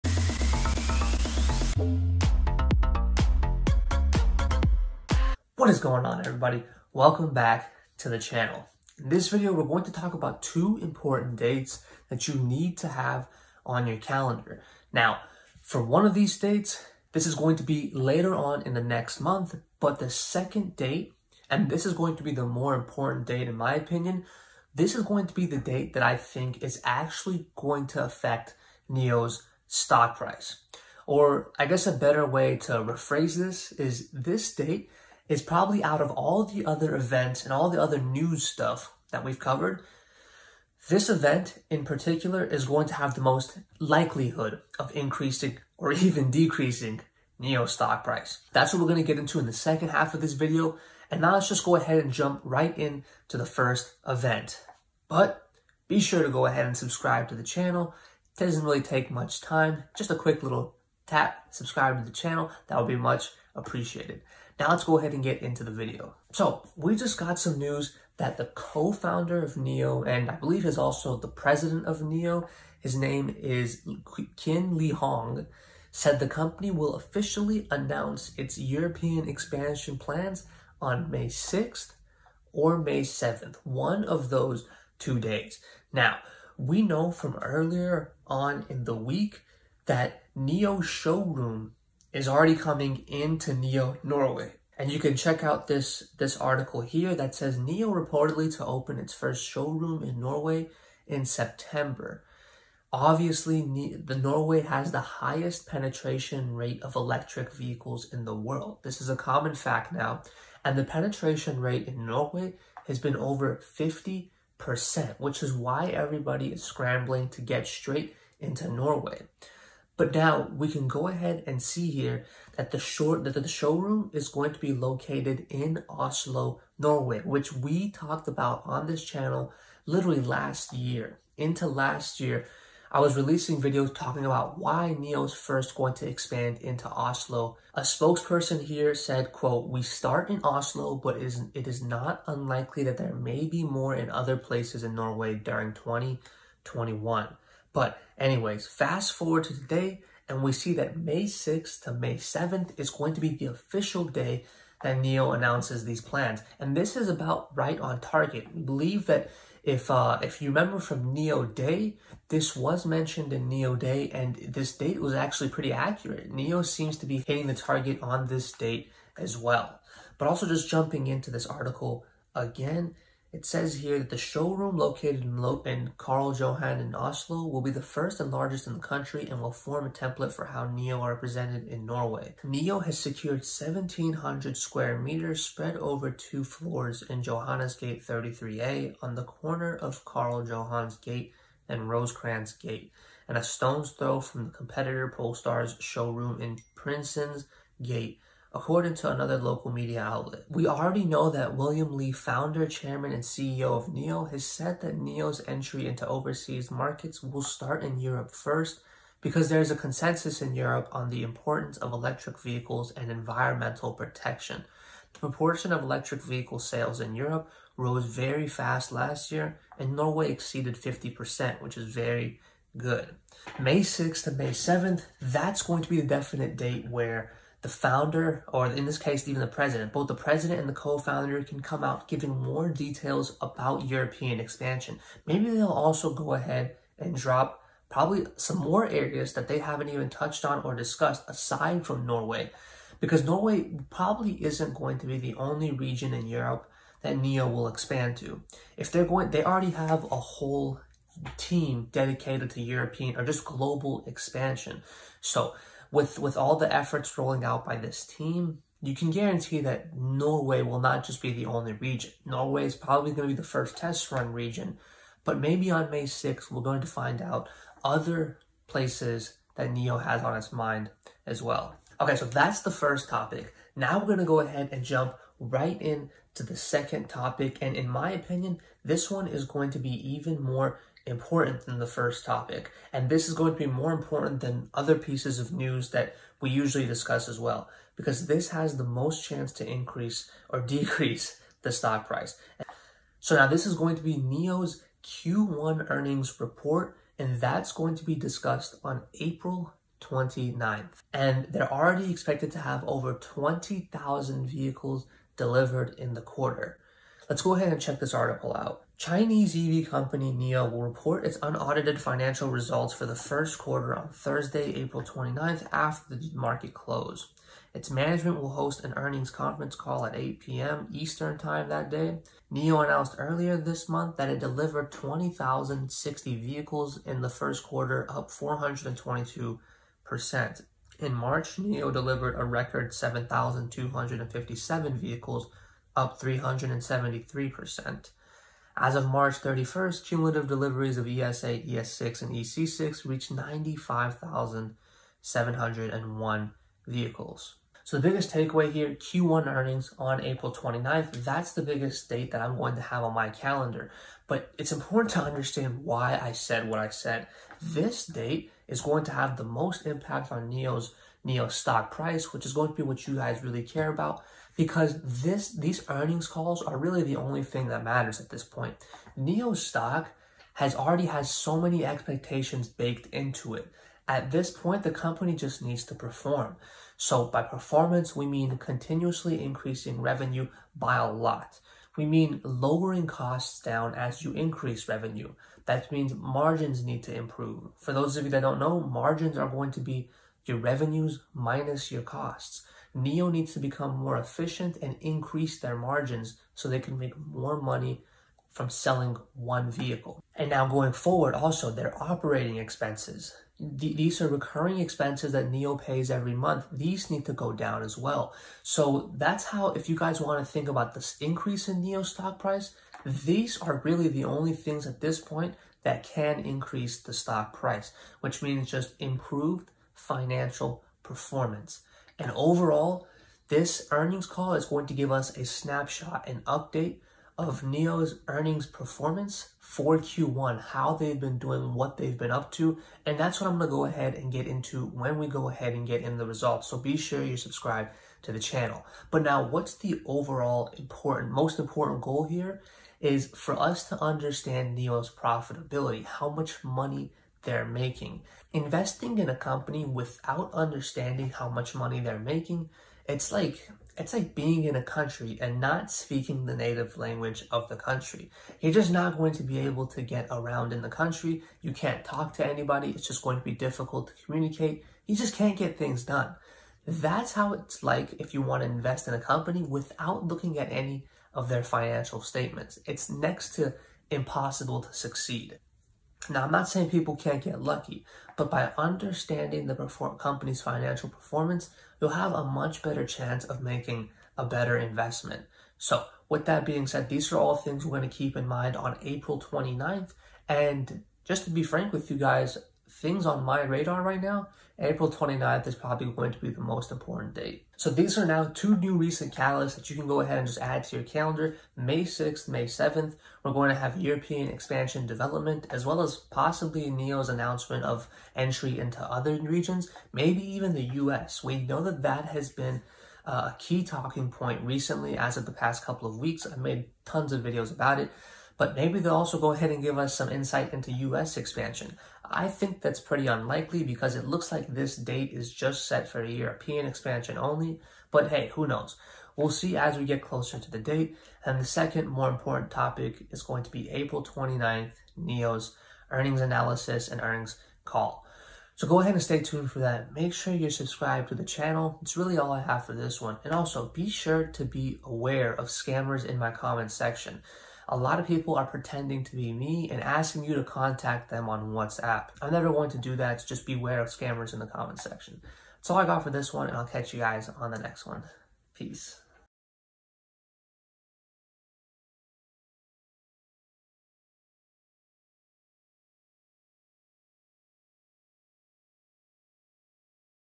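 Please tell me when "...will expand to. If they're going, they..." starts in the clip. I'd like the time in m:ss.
4:07.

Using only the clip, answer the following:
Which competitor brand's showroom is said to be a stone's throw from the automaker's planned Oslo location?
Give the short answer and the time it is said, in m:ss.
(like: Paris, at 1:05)
Polestar, at 3:15.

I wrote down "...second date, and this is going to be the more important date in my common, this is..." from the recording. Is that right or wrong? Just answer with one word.
wrong.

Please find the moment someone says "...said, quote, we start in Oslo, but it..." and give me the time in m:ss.
2:18.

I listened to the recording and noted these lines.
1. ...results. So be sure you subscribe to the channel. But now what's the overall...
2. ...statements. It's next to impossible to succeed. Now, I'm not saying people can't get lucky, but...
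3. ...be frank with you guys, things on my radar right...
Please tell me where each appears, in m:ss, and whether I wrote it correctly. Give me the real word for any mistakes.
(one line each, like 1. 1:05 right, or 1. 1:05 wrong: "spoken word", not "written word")
1. 7:16 right
2. 7:52 right
3. 8:11 right.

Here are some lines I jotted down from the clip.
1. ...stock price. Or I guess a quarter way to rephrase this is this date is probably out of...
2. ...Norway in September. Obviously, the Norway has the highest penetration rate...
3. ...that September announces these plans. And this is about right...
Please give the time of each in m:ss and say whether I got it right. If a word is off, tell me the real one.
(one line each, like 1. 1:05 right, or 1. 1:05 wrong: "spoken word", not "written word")
1. 0:29 wrong: "better", not "quarter"
2. 1:40 right
3. 2:34 wrong: "NIO", not "September".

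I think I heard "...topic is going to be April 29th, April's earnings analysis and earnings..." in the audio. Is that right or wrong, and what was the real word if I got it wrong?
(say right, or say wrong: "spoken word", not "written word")
wrong: "NIO", not "April".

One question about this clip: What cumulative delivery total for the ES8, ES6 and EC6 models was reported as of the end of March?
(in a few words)
95,701.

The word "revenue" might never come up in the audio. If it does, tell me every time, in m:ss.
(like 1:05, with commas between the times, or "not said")
6:20, 6:24, 6:30.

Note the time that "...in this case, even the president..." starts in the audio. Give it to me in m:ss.
3:48.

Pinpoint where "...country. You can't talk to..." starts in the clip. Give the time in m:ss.
7:40.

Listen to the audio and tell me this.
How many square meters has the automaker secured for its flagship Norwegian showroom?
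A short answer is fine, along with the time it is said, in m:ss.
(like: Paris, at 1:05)
1,700, at 3:03.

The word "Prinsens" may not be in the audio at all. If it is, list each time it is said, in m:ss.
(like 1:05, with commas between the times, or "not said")
3:16.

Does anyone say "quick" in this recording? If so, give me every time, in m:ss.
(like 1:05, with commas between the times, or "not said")
1:00.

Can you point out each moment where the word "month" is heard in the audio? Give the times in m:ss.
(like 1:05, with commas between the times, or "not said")
0:19, 5:23, 6:46.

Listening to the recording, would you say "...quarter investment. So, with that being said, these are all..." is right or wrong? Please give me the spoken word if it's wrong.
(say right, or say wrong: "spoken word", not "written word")
wrong: "better", not "quarter".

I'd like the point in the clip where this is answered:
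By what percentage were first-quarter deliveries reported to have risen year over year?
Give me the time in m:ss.
5:28.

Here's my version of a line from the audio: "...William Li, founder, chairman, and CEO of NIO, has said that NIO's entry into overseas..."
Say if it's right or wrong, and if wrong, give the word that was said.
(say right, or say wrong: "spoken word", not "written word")
right.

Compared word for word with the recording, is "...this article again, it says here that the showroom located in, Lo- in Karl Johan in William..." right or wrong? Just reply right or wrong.
wrong.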